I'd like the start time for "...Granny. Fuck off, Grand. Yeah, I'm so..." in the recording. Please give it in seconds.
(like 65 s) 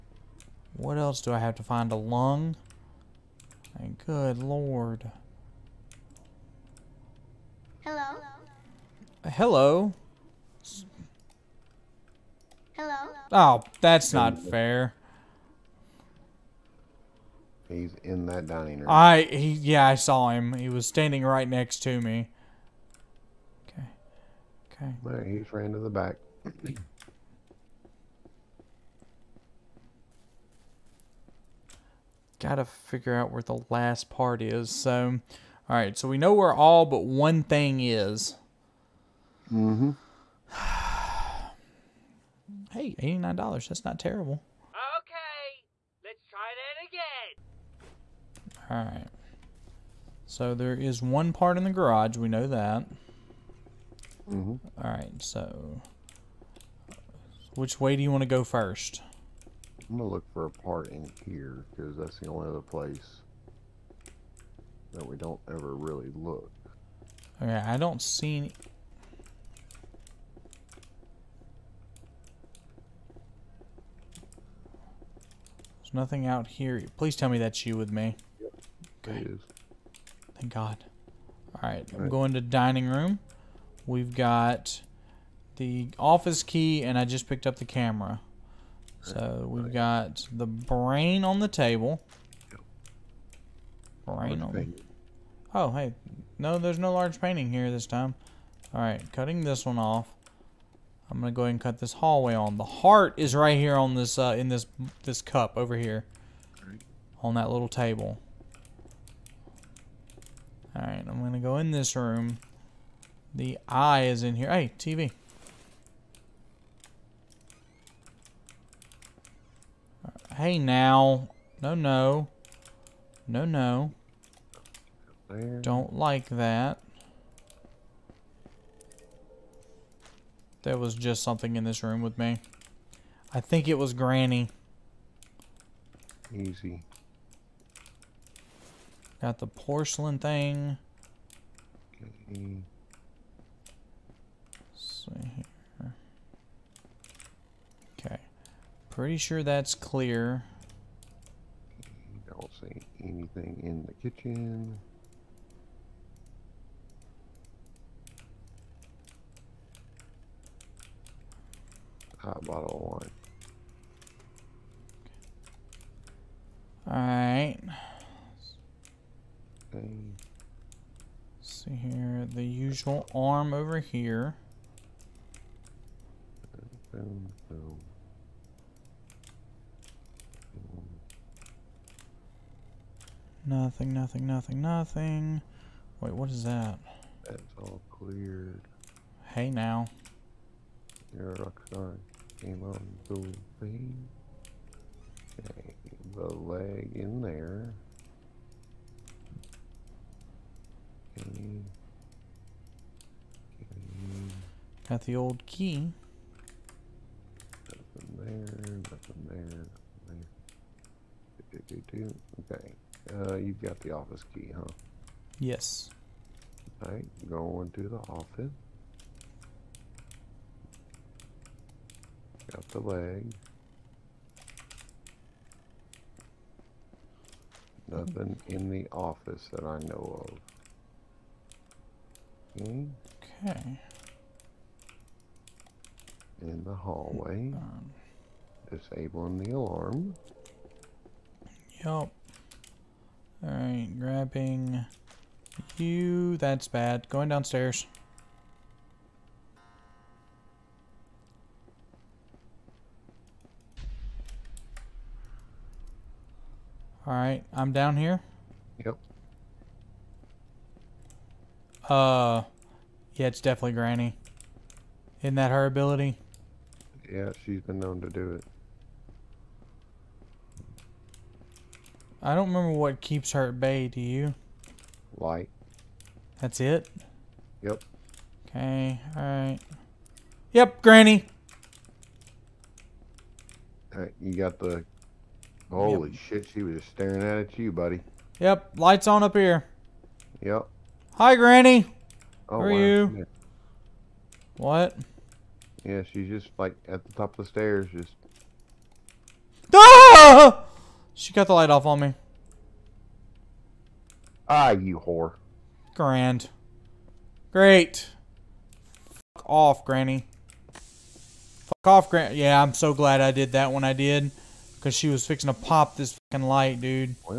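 309 s.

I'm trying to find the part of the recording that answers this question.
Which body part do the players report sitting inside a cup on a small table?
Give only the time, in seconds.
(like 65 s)
102 s.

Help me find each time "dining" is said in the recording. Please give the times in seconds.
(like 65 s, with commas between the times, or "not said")
18 s, 82 s.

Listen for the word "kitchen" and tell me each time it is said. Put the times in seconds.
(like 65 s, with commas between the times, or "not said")
154 s.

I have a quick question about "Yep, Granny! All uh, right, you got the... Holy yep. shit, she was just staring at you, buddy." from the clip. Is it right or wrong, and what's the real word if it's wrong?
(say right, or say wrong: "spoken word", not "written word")
right.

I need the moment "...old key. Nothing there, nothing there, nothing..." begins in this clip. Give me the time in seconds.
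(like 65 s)
205 s.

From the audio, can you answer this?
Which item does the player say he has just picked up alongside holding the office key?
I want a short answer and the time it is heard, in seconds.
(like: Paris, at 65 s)
The camera, at 87 s.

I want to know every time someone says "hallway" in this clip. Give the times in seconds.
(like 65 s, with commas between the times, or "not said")
101 s, 236 s.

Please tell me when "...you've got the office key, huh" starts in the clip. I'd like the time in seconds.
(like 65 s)
213 s.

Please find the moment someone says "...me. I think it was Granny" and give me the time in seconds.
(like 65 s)
132 s.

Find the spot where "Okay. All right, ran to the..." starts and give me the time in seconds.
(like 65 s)
24 s.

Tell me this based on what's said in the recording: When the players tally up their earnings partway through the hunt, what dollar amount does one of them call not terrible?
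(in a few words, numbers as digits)
$89.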